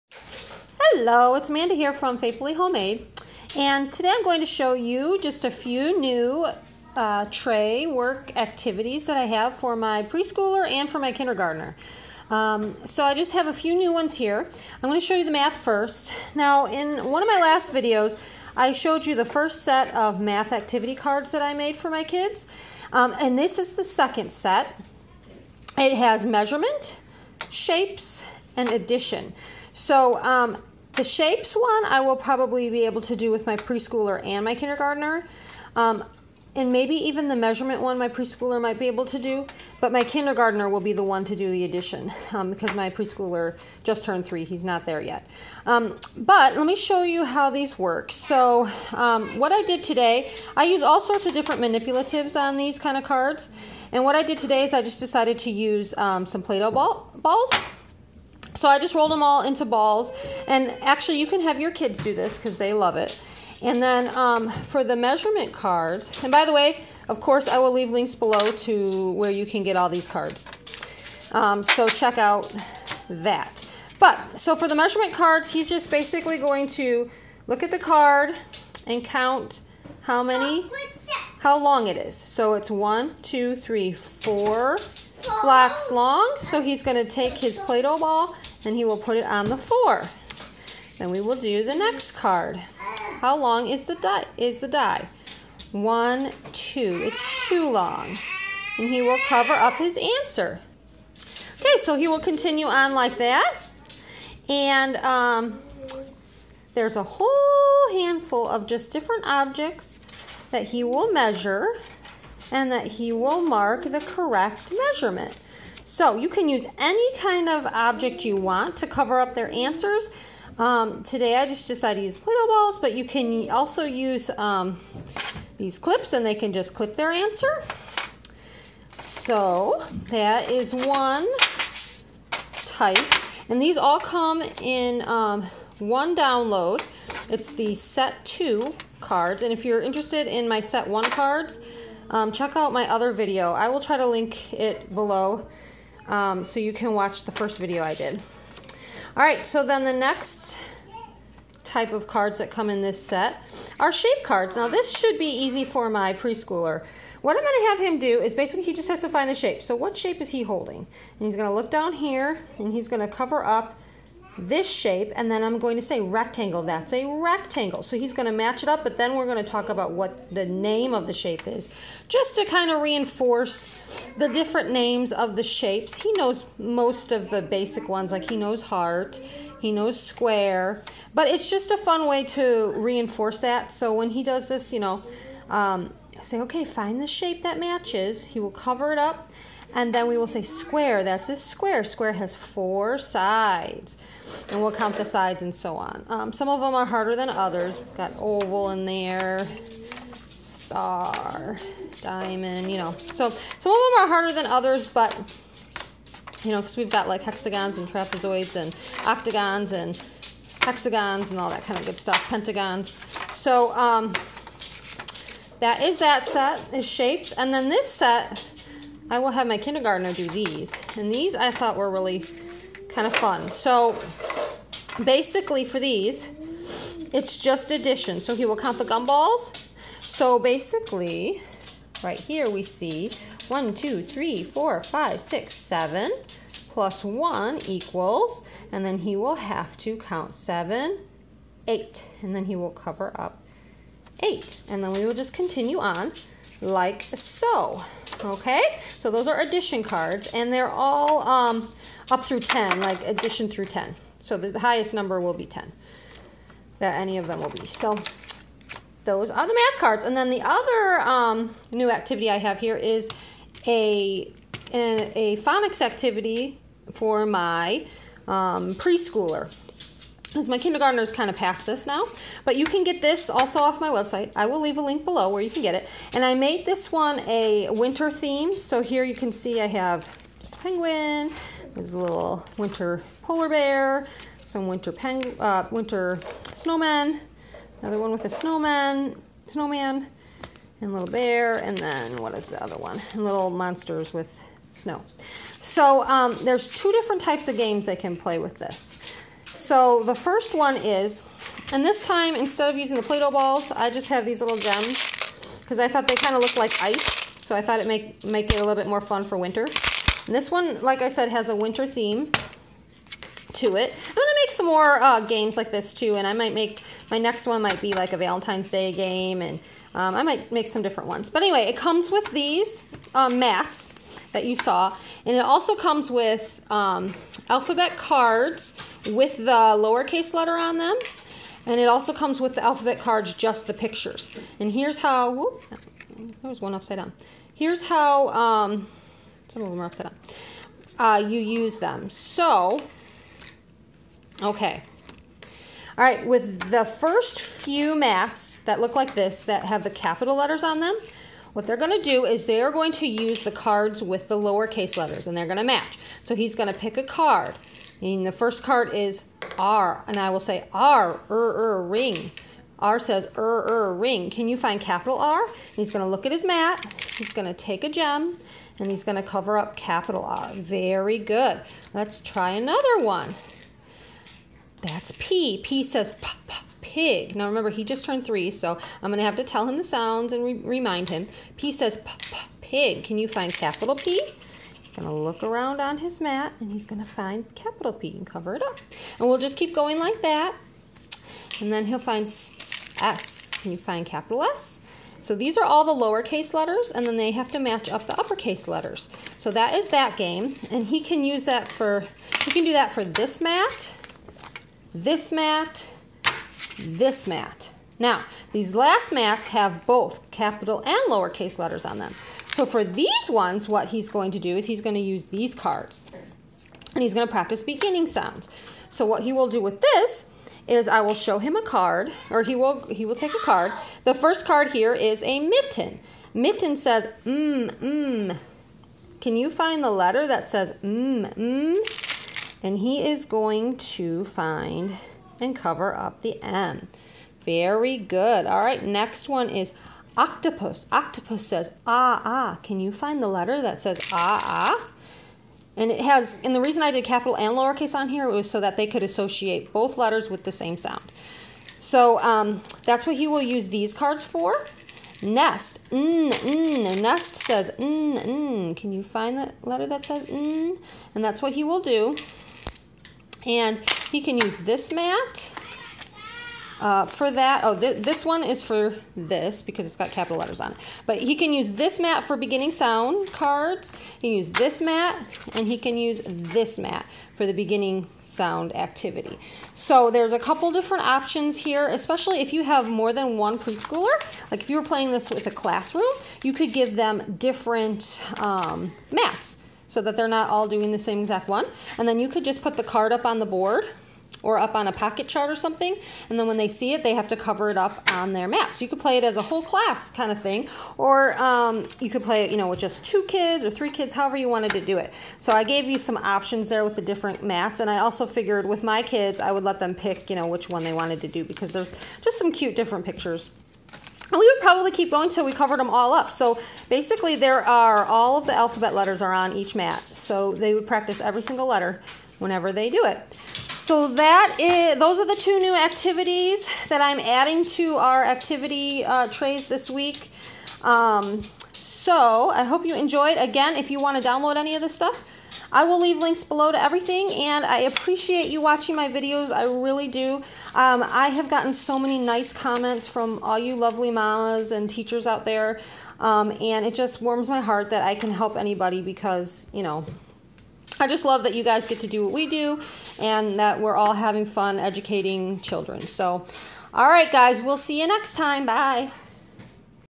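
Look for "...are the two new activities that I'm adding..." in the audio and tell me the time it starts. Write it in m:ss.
8:45.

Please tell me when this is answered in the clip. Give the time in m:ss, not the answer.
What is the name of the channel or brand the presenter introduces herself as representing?
0:02.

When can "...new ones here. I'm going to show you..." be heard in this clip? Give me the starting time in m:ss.
0:13.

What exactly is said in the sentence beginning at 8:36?
So basically there are, all of the alphabet letters are on each mat.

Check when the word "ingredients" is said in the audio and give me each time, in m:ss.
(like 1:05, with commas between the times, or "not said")
not said.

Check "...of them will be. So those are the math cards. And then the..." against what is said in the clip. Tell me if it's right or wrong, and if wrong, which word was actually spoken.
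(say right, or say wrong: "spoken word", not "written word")
right.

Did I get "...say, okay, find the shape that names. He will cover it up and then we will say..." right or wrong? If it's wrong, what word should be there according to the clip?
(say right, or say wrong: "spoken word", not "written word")
wrong: "matches", not "names".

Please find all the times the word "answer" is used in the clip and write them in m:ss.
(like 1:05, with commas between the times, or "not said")
1:39, 1:59, 2:07.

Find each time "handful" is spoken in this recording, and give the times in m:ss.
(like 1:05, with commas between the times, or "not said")
1:47.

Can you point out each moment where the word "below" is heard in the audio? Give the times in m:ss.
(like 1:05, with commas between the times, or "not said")
1:08, 2:24, 4:35, 8:56.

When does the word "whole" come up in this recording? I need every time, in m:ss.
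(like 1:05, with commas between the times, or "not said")
1:47, 8:19.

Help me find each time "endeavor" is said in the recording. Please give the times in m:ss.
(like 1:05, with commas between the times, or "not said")
not said.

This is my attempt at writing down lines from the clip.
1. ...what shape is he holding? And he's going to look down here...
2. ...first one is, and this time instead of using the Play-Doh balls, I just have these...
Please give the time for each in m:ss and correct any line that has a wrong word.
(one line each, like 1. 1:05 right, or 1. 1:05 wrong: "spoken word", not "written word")
1. 2:39 right
2. 5:00 right.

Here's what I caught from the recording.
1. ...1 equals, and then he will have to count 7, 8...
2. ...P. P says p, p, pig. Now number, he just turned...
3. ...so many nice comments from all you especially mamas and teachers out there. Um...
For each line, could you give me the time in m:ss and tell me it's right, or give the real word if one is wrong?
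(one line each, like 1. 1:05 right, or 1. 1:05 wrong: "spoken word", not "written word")
1. 3:57 right
2. 6:15 wrong: "remember", not "number"
3. 9:01 wrong: "lovely", not "especially".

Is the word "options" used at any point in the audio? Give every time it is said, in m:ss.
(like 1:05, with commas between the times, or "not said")
8:01, 8:26.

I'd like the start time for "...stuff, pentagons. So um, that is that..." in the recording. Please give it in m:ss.
3:31.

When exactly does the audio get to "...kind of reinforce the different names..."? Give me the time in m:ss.
2:52.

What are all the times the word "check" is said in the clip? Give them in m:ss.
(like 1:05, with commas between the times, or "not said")
1:11, 2:22.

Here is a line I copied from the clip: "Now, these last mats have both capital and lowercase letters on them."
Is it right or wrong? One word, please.
right.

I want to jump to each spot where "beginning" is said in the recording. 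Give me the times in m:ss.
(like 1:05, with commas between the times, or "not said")
6:57, 7:52, 7:57.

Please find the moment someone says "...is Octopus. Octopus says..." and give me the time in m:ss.
7:19.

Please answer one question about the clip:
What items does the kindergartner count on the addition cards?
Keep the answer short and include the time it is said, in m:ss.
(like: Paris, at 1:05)
Gumballs, at 3:48.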